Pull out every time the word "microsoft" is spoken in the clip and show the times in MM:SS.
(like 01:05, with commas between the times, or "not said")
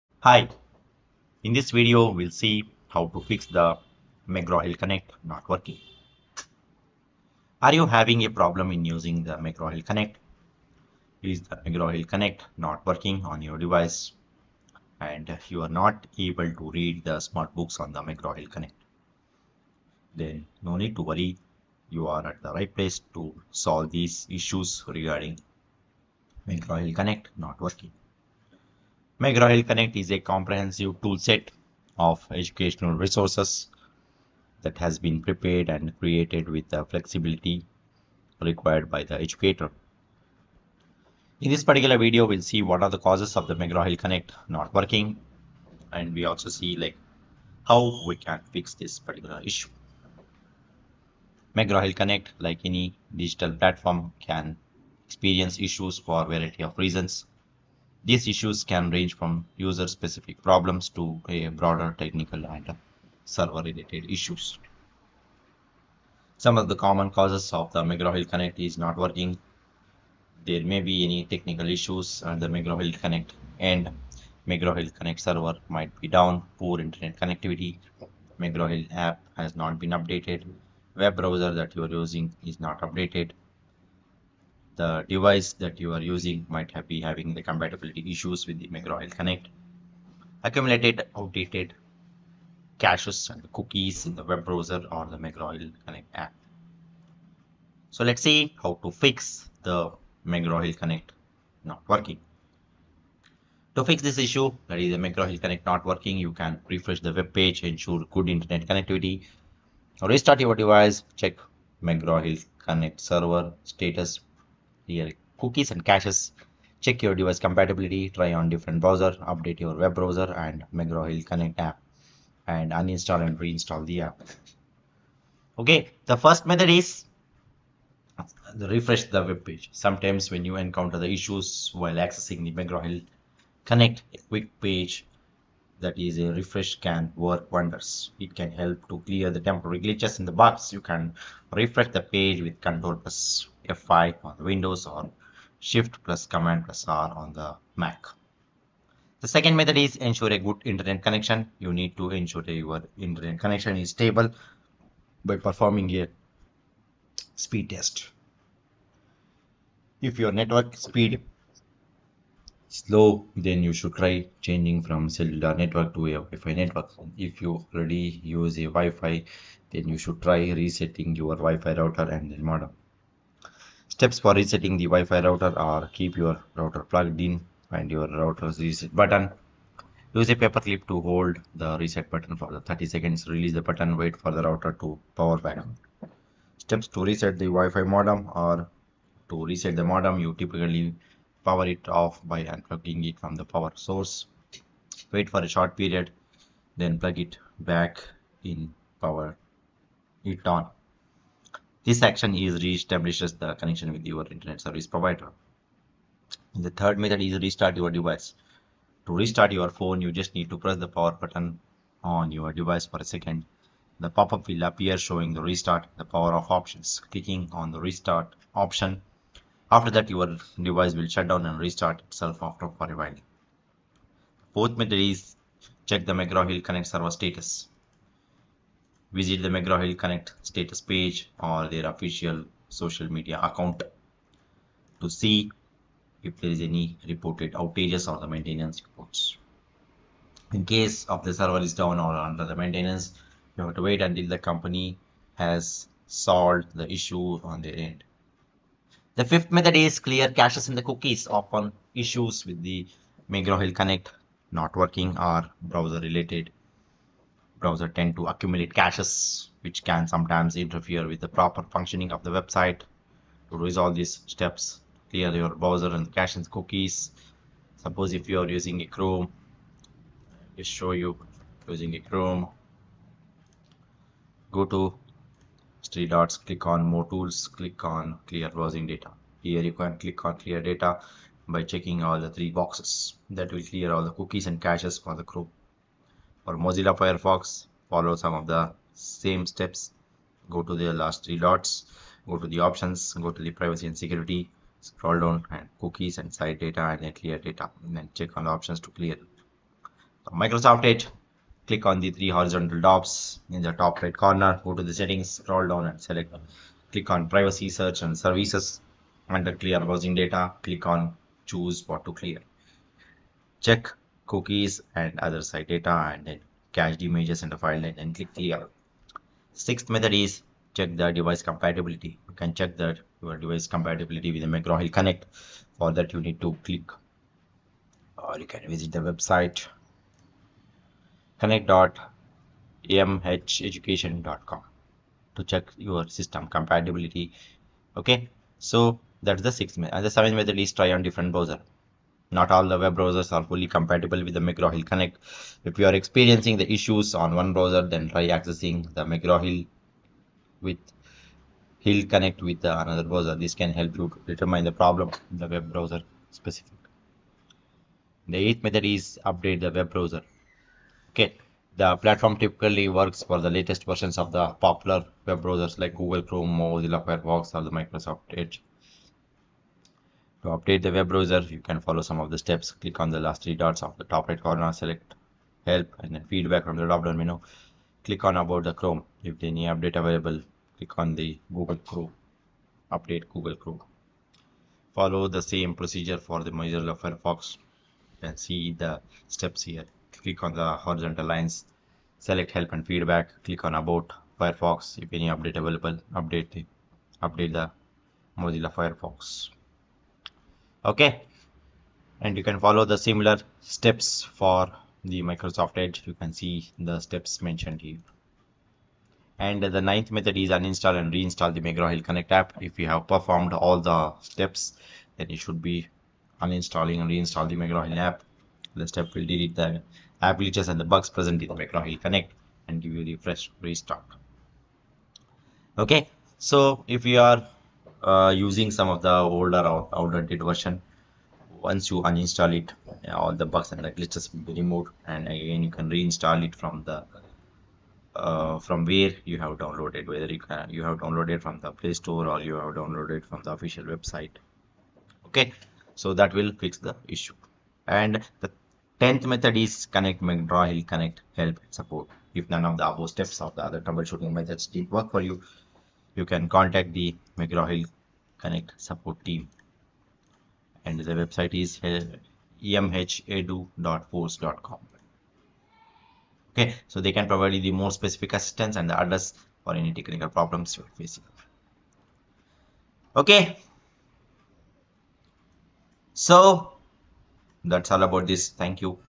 05:00, 06:07, 06:45.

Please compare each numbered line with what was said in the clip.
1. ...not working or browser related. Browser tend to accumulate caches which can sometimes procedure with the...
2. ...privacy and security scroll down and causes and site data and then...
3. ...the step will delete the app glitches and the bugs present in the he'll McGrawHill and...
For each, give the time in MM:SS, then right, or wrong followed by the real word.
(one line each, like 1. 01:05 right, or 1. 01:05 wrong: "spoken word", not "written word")
1. 04:14 wrong: "interfere", not "procedure"
2. 04:53 wrong: "cookies", not "causes"
3. 06:58 wrong: "Connect", not "McGrawHill".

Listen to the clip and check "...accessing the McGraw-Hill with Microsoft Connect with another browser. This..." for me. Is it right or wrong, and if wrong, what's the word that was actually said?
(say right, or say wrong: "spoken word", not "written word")
wrong: "Hill", not "Microsoft".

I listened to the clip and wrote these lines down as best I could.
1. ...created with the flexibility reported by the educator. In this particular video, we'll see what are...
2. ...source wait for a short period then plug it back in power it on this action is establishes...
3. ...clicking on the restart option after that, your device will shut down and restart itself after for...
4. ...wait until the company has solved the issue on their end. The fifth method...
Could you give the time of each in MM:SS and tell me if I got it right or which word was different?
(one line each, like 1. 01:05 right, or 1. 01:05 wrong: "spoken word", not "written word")
1. 00:35 wrong: "required", not "reported"
2. 03:13 right
3. 03:37 right
4. 04:03 right.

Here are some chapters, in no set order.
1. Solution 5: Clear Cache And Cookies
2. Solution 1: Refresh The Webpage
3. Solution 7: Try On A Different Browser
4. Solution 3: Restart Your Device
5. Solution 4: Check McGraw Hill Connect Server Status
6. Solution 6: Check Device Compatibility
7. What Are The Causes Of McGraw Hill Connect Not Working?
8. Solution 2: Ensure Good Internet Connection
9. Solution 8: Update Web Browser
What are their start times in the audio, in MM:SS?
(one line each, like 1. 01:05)
1. 04:10
2. 02:06
3. 05:41
4. 03:27
5. 03:49
6. 05:20
7. 00:44
8. 02:42
9. 06:11.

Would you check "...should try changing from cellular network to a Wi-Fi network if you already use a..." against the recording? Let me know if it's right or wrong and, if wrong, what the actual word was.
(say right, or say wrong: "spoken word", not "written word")
right.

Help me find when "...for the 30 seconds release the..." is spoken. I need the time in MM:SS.
03:02.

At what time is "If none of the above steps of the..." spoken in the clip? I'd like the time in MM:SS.
07:32.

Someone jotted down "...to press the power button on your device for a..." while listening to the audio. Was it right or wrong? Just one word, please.
right.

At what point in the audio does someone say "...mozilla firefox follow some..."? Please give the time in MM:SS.
04:46.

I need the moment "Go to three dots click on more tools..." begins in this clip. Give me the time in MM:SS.
04:34.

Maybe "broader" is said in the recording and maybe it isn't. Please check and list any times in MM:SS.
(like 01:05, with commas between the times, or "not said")
01:01.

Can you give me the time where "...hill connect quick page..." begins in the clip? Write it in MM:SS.
02:12.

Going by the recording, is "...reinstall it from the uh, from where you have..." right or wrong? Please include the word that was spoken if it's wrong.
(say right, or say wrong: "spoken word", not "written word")
right.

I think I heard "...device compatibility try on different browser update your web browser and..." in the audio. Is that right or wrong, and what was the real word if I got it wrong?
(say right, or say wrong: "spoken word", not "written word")
right.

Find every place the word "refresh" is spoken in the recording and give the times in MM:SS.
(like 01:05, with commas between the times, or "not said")
01:46, 02:08, 02:16, 02:21.